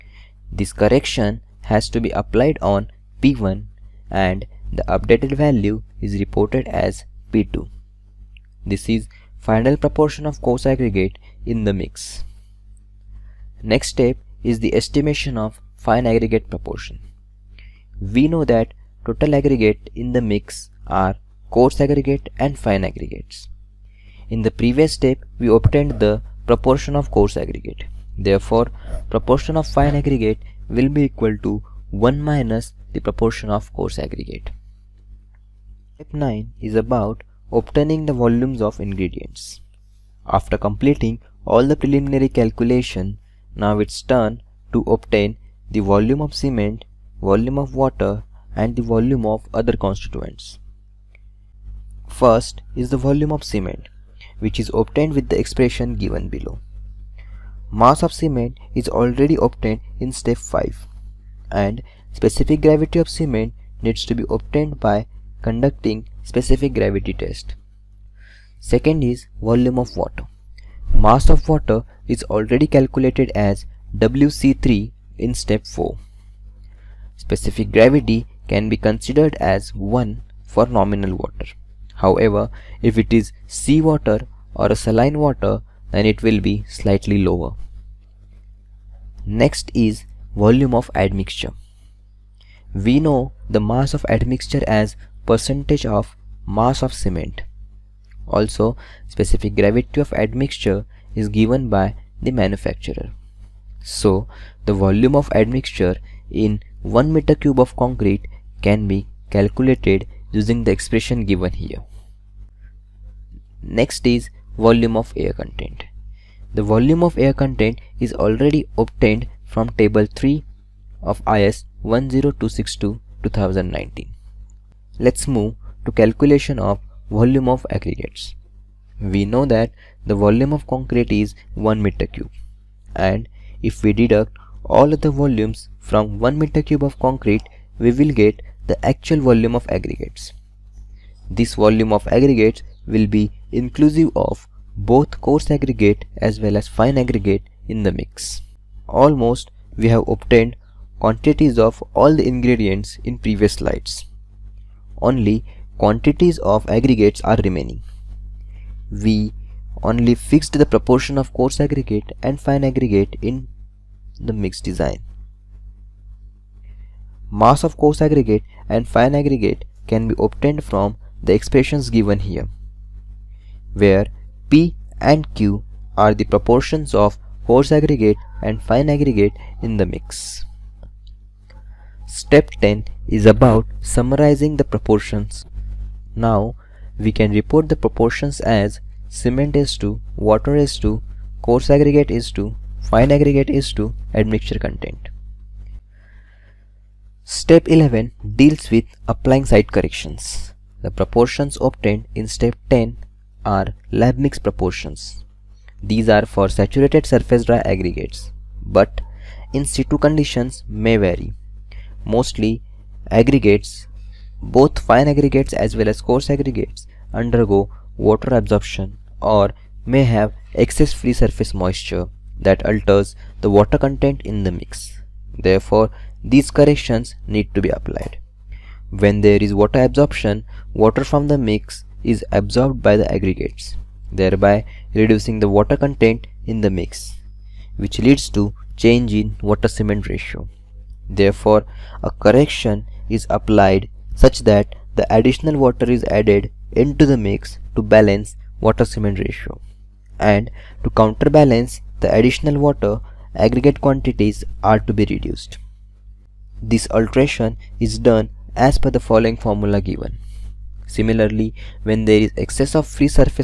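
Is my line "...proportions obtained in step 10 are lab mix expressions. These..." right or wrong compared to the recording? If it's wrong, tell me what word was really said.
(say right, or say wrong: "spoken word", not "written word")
wrong: "proportions", not "expressions".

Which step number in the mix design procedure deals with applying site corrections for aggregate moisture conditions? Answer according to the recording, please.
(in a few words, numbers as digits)
Step 11.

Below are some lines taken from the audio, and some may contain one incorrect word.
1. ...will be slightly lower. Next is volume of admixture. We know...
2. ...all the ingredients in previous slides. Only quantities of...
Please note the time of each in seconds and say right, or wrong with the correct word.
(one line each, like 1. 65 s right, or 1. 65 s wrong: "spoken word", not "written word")
1. 86 s right
2. 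151 s right.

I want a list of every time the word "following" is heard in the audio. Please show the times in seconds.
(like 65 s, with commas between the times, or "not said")
258 s.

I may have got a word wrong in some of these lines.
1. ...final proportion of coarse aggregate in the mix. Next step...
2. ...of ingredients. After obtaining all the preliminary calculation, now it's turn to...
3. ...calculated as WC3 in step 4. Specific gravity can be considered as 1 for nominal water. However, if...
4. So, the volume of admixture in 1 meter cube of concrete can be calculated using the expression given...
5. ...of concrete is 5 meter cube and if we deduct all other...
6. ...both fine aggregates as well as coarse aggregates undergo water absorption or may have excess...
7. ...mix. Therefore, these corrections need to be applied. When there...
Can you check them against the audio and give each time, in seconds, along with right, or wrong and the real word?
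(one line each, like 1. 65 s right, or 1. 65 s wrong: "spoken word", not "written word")
1. 9 s right
2. 38 s wrong: "completing", not "obtaining"
3. 72 s right
4. 103 s right
5. 130 s wrong: "1", not "5"
6. 214 s right
7. 224 s right.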